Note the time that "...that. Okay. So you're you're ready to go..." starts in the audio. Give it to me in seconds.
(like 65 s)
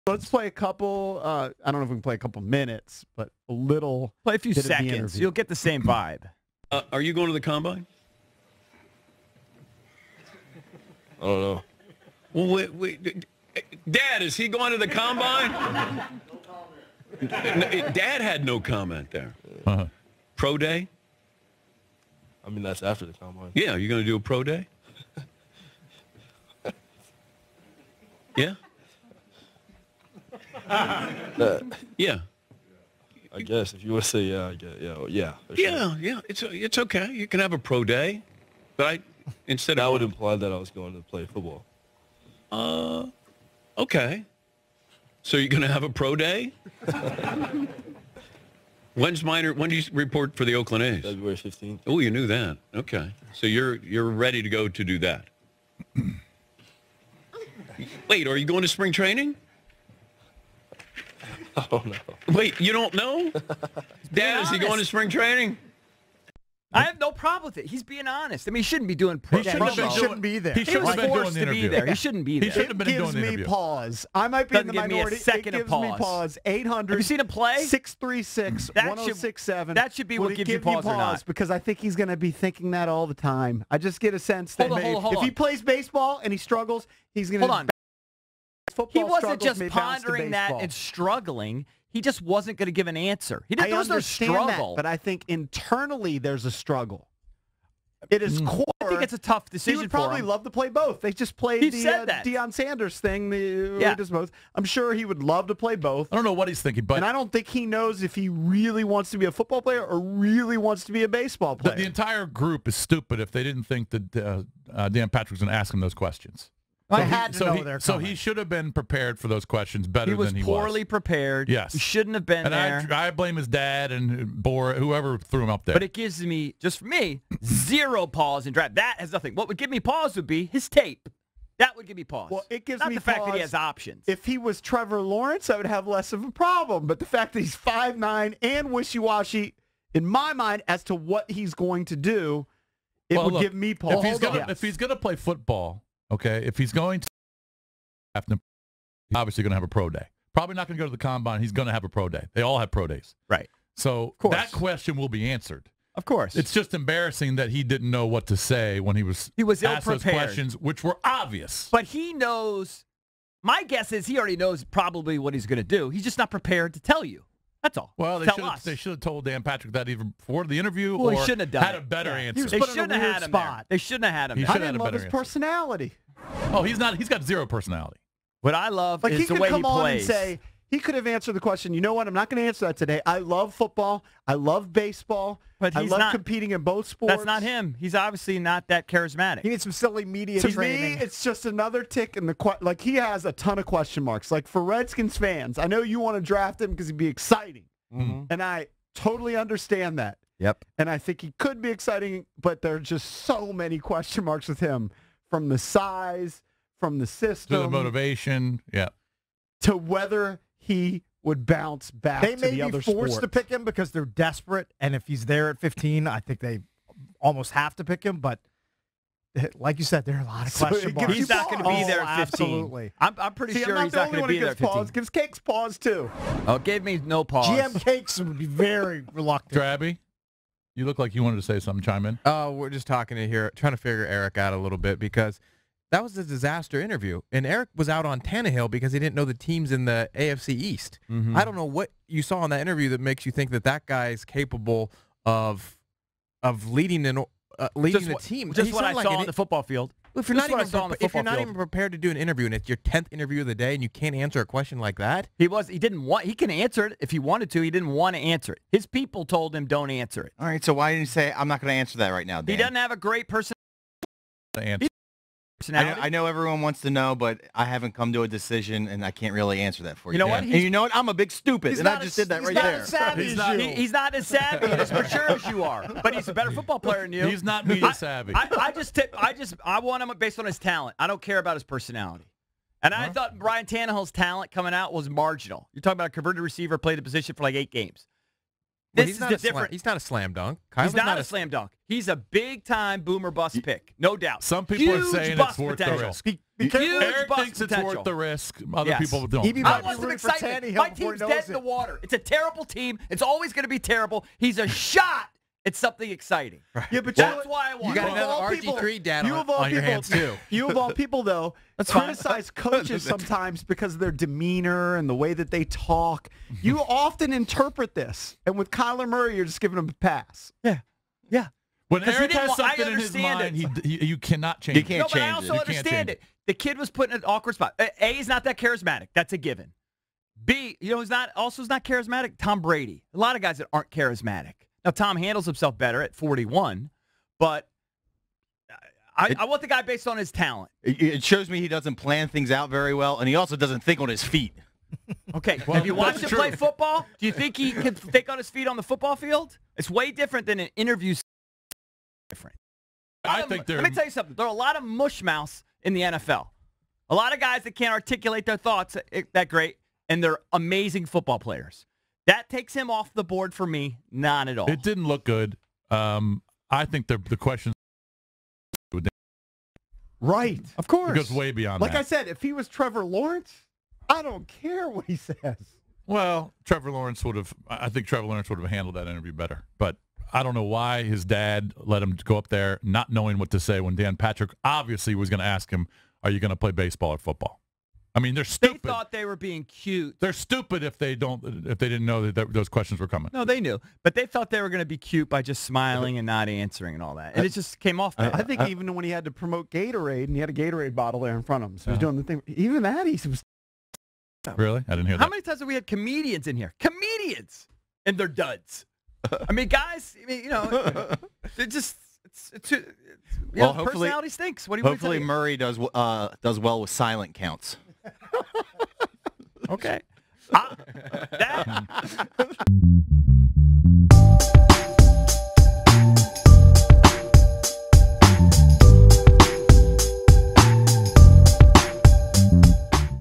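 52 s.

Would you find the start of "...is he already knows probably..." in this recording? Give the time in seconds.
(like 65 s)
163 s.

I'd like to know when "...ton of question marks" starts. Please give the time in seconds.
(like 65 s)
193 s.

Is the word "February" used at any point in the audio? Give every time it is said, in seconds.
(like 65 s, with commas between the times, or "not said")
51 s.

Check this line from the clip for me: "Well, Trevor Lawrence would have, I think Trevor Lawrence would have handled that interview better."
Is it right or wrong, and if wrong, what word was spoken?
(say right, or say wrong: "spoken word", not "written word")
right.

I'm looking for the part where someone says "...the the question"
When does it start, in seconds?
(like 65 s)
367 s.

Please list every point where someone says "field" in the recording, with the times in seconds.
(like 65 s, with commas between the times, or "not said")
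249 s, 349 s.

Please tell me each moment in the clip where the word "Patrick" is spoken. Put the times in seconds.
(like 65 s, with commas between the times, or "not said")
115 s, 169 s, 384 s.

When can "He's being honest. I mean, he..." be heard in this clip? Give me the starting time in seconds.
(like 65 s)
67 s.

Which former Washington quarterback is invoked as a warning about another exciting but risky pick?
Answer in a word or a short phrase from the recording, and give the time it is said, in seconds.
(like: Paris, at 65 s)
RG3, at 308 s.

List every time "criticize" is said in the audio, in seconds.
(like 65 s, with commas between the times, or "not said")
311 s.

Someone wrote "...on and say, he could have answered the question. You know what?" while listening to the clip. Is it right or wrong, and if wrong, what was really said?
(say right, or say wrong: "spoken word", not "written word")
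right.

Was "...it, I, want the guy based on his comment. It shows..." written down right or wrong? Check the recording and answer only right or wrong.
wrong.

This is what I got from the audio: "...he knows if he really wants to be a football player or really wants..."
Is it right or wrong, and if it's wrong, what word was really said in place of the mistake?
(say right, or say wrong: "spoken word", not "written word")
right.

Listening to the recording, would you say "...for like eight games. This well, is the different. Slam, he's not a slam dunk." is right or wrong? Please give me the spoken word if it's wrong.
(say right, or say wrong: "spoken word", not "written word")
right.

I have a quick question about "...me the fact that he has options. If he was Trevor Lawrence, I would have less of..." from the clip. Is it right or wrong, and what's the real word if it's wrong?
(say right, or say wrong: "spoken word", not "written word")
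right.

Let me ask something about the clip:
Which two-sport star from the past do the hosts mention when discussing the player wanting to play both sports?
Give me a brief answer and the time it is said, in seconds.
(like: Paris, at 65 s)
Deion Sanders, at 102 s.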